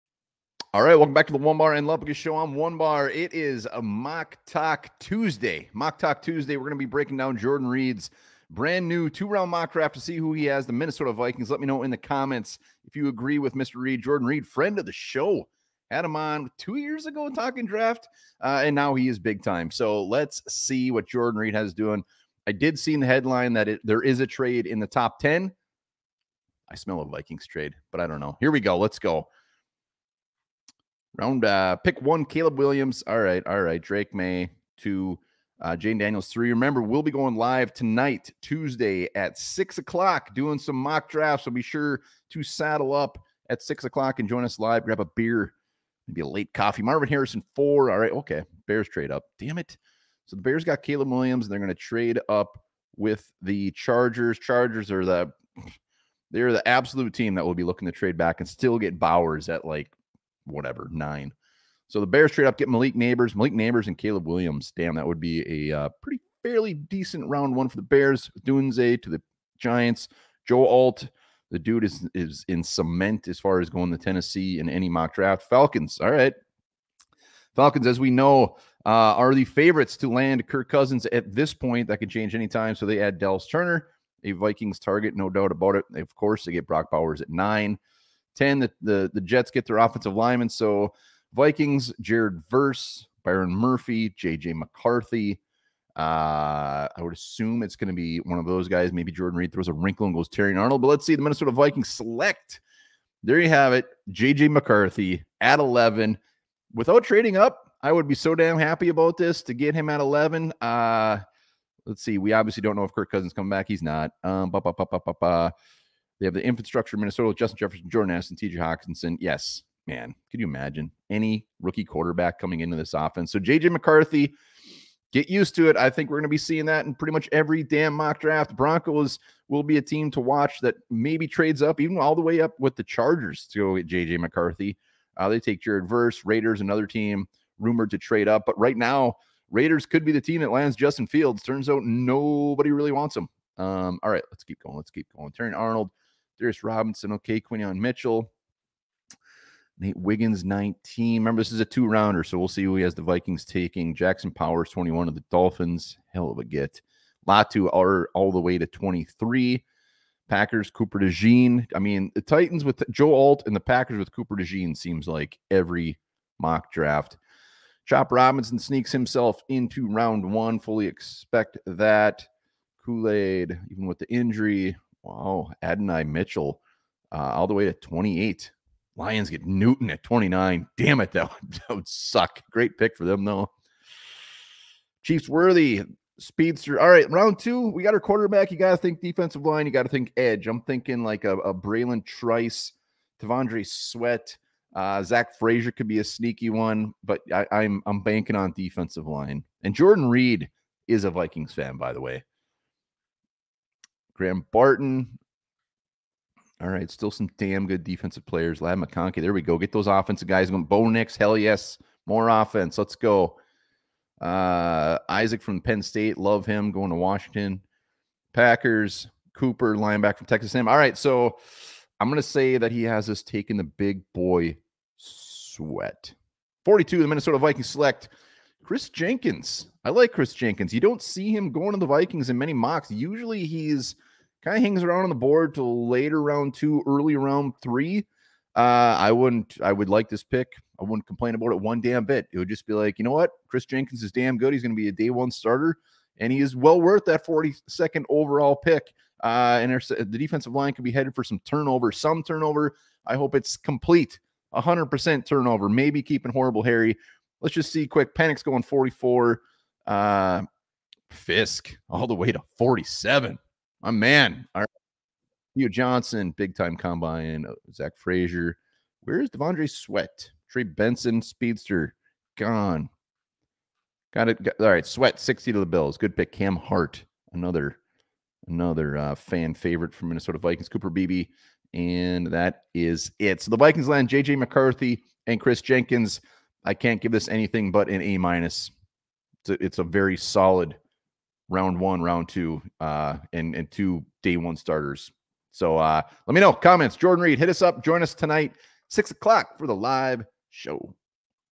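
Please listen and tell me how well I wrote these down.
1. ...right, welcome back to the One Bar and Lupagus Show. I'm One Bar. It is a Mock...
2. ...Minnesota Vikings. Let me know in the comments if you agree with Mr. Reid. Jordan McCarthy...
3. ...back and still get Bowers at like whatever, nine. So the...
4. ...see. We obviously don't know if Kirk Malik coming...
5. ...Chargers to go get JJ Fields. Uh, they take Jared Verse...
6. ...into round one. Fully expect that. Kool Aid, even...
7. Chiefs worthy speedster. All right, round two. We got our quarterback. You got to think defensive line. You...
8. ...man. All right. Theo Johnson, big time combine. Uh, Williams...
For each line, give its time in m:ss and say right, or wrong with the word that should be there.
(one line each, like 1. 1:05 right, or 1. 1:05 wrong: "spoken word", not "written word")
1. 0:00 right
2. 0:10 wrong: "Reid", not "McCarthy"
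3. 0:58 right
4. 1:52 wrong: "Cousins", not "Malik"
5. 2:12 wrong: "McCarthy", not "Fields"
6. 2:49 right
7. 3:05 right
8. 4:23 wrong: "Zach", not "Williams".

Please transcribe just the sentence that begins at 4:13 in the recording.
I hope it's complete, 100% turnover, maybe keeping horrible Harry.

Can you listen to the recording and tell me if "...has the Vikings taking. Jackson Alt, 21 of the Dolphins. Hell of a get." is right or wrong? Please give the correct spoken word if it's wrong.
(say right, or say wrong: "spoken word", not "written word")
wrong: "Powers", not "Alt".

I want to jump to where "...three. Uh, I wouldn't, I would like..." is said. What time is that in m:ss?
3:57.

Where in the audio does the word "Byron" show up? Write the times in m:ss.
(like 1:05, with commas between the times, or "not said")
1:33.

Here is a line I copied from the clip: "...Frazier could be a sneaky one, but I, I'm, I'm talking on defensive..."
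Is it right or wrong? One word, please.
wrong.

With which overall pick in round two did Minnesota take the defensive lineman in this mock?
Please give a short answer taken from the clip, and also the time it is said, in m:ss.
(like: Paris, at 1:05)
42, at 3:46.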